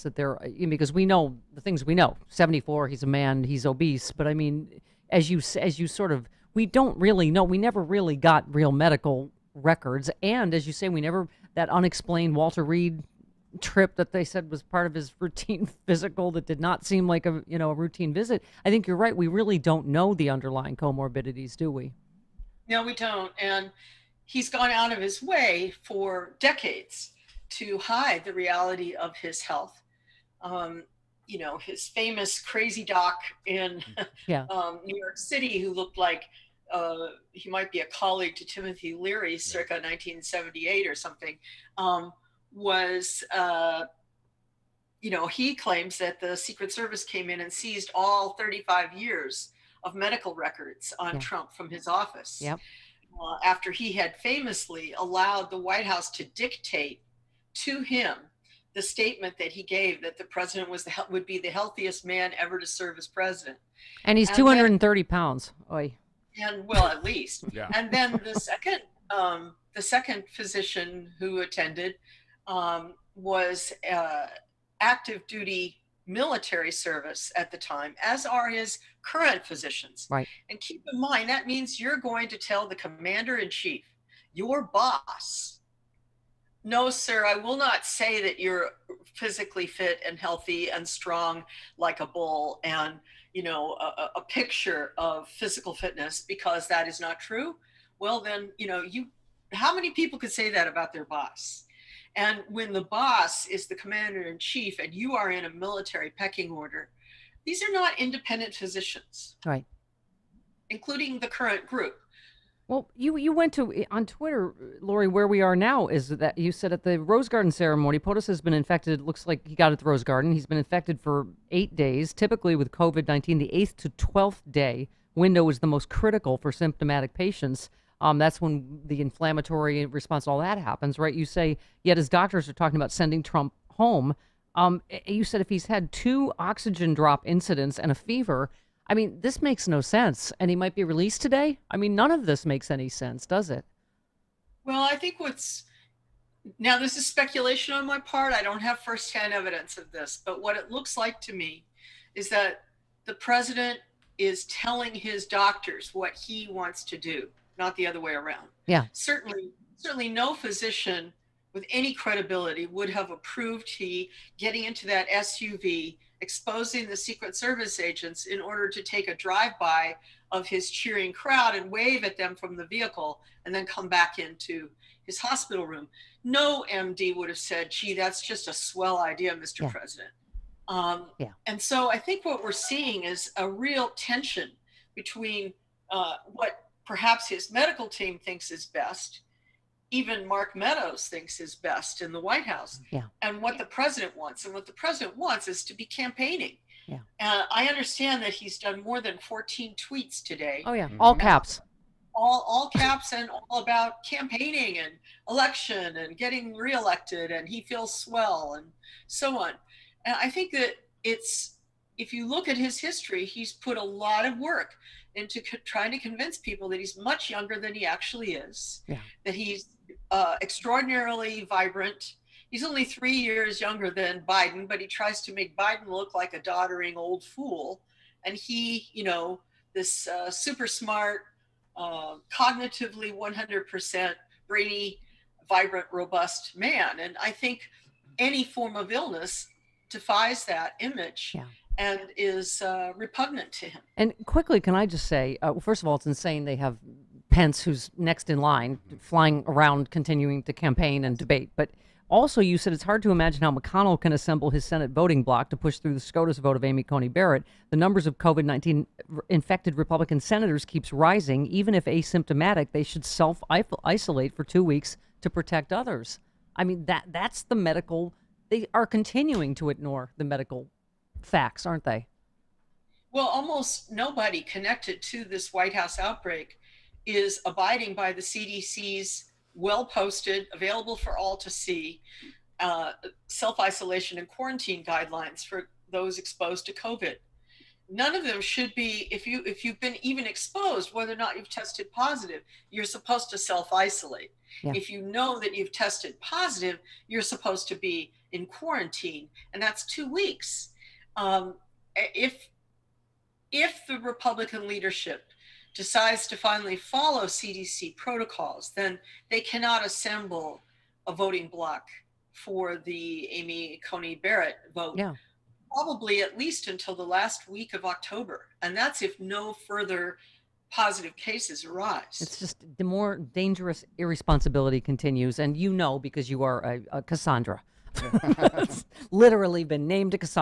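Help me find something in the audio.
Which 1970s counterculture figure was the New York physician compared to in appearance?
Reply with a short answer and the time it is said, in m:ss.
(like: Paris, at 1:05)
Timothy Leary, at 0:38.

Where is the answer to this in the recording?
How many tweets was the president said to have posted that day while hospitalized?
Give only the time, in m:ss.
3:19.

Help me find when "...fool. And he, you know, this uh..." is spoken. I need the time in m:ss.
3:47.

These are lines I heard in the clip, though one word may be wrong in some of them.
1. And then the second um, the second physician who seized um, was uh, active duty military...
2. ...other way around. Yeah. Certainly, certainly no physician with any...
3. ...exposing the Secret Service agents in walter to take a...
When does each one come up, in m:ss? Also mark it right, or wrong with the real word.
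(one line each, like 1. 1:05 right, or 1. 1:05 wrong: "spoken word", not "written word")
1. 1:07 wrong: "attended", not "seized"
2. 2:37 right
3. 2:46 wrong: "order", not "walter".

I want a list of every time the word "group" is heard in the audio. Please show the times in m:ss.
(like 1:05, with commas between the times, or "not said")
1:51.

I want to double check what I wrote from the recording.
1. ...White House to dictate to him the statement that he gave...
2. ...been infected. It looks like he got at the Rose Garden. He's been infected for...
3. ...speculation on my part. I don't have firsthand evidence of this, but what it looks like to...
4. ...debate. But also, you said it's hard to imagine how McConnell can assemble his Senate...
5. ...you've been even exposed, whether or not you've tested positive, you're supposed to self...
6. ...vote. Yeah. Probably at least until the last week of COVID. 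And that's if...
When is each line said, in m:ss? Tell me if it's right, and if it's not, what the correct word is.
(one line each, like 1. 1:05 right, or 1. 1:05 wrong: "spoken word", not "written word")
1. 0:55 right
2. 1:58 right
3. 2:27 right
4. 4:11 right
5. 4:49 right
6. 5:14 wrong: "October", not "COVID".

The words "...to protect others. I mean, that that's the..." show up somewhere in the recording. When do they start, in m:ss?
4:25.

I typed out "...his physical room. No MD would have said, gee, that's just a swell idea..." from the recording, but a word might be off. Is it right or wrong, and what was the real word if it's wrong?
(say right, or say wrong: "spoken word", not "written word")
wrong: "hospital", not "physical".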